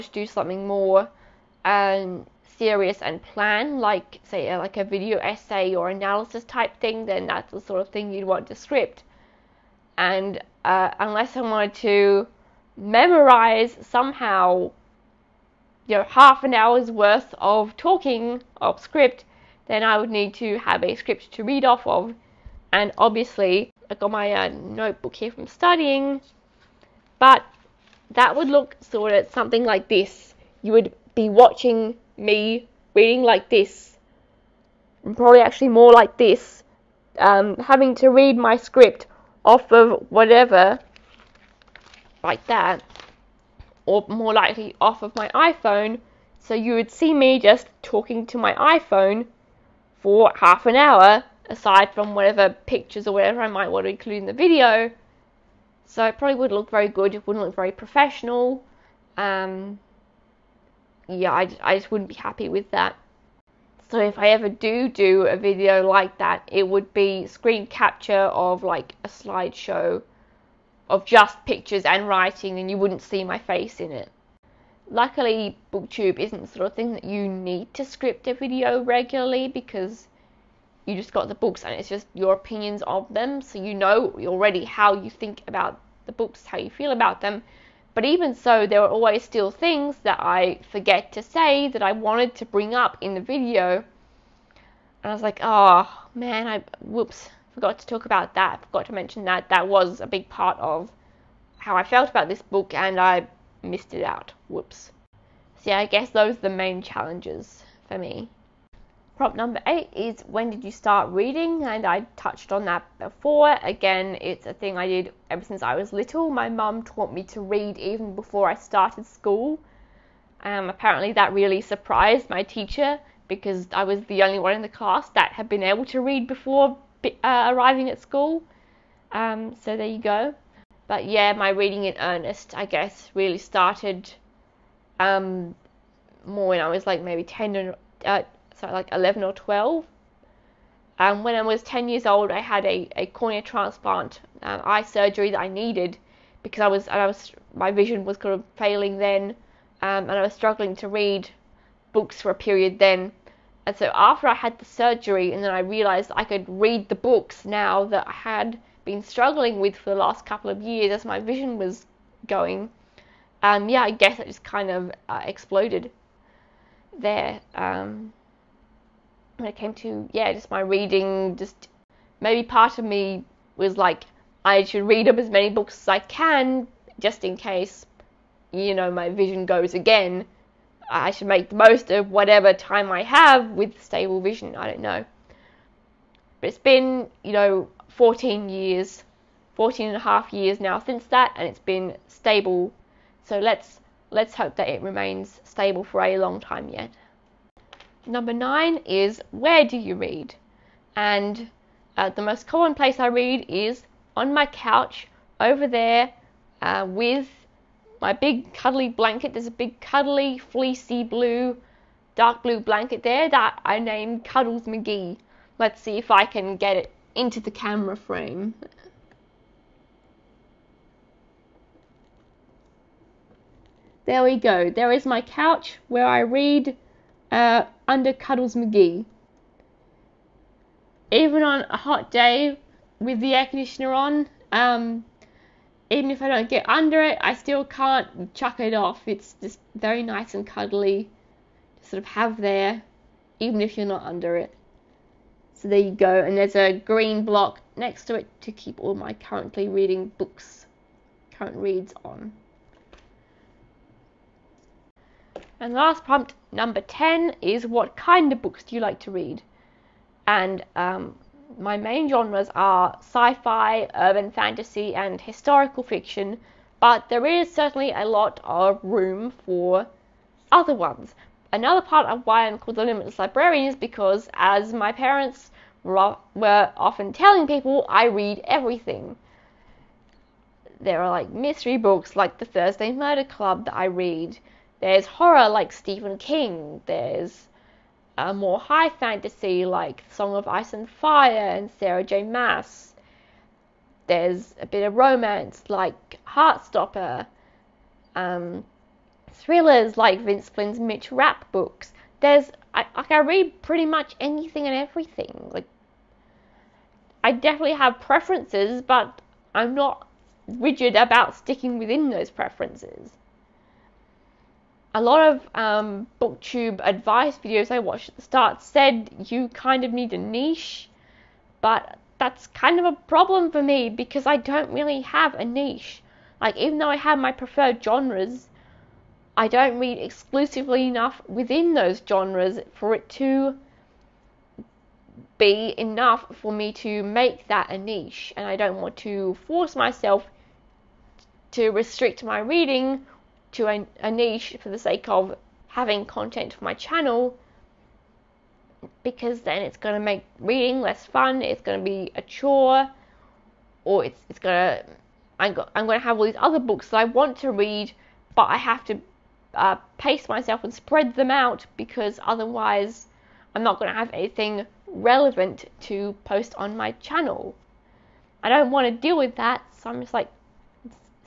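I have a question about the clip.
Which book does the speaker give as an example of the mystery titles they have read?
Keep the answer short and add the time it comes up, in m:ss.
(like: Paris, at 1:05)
The Thursday Murder Club, at 4:42.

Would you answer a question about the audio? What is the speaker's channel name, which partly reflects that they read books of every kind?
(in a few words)
The Limitless Librarian.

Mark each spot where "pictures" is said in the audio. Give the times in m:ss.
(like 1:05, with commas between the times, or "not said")
0:52, 1:11.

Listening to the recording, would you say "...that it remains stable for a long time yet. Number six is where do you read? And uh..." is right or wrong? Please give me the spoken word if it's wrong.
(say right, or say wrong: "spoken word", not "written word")
wrong: "nine", not "six".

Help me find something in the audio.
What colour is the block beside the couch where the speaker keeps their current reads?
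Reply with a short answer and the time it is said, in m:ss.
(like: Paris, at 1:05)
Green, at 4:06.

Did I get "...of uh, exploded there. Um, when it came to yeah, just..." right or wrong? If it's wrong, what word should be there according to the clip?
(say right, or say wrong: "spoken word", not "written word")
right.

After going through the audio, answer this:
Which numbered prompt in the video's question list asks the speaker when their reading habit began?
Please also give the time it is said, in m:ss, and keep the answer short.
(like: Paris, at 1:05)
8, at 1:49.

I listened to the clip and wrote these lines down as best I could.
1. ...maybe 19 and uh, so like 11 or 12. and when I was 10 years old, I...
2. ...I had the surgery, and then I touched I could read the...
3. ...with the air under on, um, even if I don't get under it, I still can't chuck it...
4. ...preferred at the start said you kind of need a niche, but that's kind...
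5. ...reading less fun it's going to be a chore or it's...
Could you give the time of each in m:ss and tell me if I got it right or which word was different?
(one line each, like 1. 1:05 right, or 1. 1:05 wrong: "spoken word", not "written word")
1. 2:17 wrong: "10", not "19"
2. 2:34 wrong: "realized", not "touched"
3. 3:52 wrong: "conditioner", not "under"
4. 5:17 wrong: "watched", not "preferred"
5. 5:50 right.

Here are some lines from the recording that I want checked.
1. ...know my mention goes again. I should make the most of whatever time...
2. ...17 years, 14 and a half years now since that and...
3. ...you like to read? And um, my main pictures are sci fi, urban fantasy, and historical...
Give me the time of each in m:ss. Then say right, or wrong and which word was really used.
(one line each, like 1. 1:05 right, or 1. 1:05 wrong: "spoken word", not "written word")
1. 2:58 wrong: "vision", not "mention"
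2. 3:07 wrong: "14", not "17"
3. 4:18 wrong: "genres", not "pictures".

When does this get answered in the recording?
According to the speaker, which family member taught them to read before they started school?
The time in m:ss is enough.
1:56.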